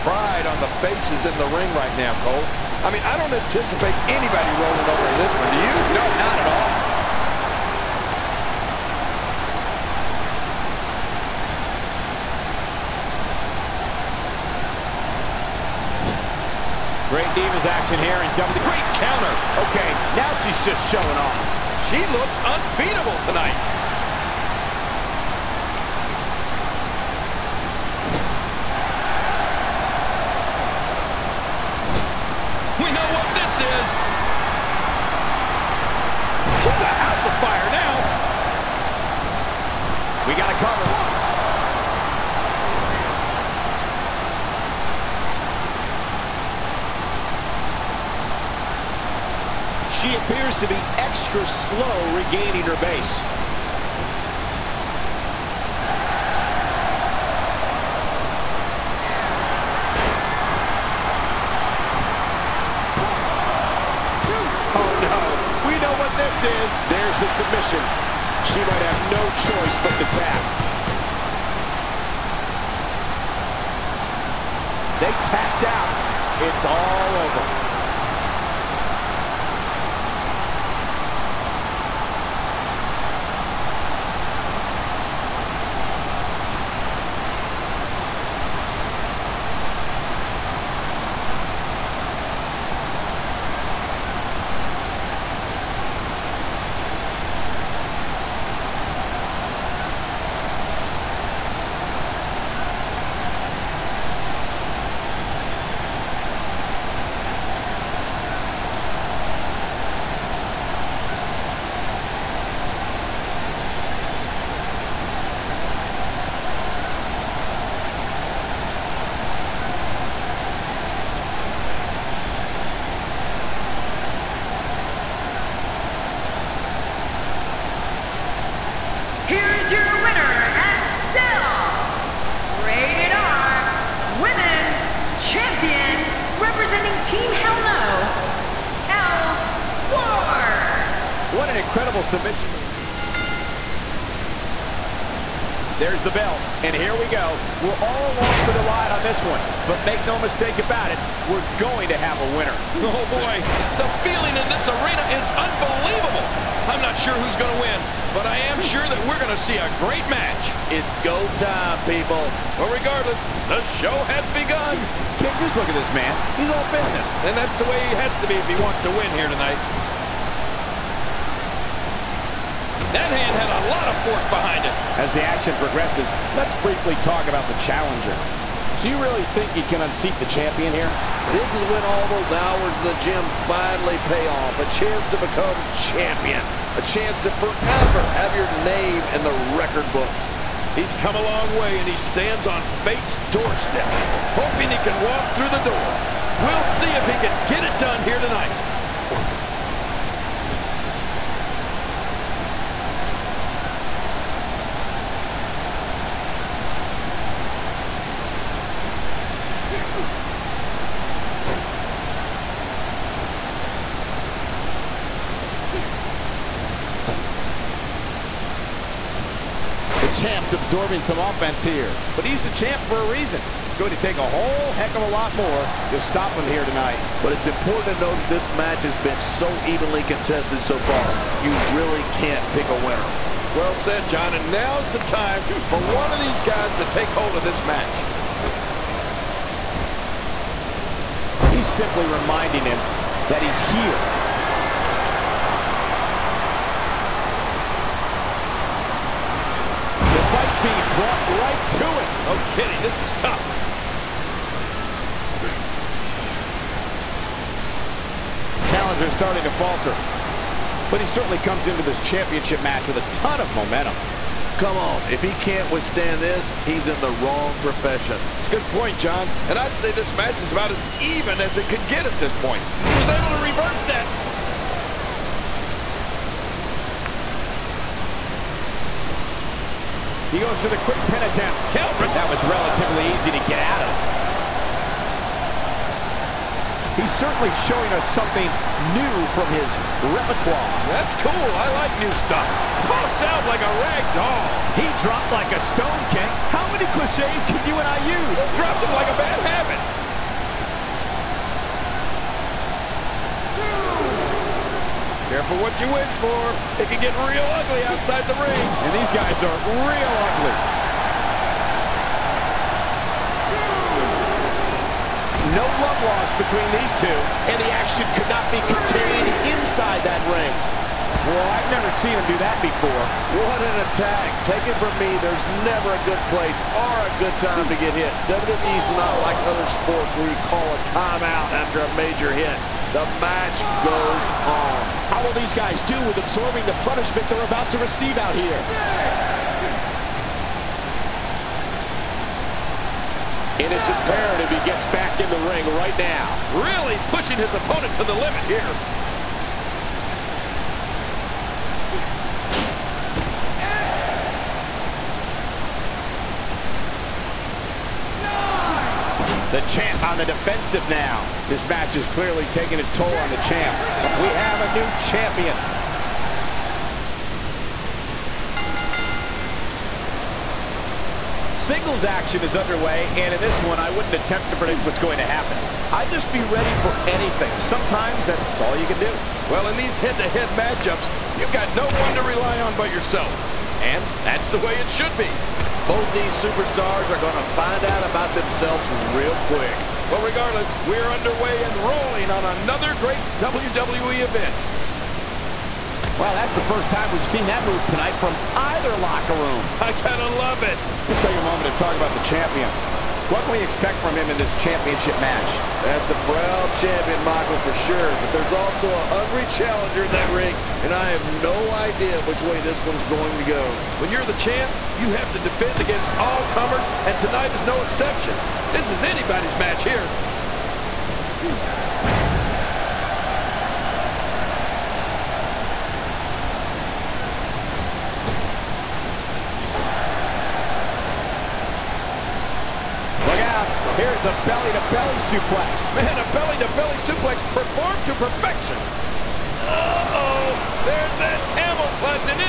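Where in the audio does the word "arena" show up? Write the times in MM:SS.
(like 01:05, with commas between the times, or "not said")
02:34.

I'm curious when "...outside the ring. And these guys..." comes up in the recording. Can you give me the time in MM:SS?
05:07.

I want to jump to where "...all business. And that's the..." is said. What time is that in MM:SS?
02:46.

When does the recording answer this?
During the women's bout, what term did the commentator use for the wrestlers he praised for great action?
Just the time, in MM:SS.
00:17.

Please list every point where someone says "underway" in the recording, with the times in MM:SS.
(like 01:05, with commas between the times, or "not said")
06:12, 06:31.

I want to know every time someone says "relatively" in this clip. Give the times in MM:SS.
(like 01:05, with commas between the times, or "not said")
04:42.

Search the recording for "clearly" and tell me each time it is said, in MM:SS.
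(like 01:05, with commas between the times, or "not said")
06:02.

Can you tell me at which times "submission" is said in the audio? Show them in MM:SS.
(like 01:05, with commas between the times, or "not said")
01:07, 02:22.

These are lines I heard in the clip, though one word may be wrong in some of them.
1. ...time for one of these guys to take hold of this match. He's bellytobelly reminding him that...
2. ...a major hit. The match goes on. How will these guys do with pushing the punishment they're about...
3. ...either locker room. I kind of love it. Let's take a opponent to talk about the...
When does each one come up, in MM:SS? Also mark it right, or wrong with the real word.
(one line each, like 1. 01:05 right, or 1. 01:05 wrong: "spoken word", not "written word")
1. 03:54 wrong: "simply", not "bellytobelly"
2. 05:31 wrong: "absorbing", not "pushing"
3. 06:38 wrong: "moment", not "opponent".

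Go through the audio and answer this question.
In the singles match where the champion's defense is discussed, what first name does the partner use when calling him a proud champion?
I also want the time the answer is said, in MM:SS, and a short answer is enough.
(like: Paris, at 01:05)
Michael, at 06:47.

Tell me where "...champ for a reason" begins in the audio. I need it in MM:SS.
03:42.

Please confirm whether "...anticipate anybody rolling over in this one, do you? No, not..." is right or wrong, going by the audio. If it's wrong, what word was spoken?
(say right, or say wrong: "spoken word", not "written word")
right.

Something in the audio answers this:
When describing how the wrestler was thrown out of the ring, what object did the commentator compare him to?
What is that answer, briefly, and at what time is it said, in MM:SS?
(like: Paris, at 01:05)
rag doll, at 04:53.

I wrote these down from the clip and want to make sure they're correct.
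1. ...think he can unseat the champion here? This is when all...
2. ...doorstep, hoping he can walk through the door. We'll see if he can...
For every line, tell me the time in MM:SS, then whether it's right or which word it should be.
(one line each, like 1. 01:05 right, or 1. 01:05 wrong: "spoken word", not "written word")
1. 02:59 right
2. 03:13 right.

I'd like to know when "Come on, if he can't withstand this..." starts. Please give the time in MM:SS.
04:24.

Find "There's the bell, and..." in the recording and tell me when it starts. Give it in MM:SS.
02:25.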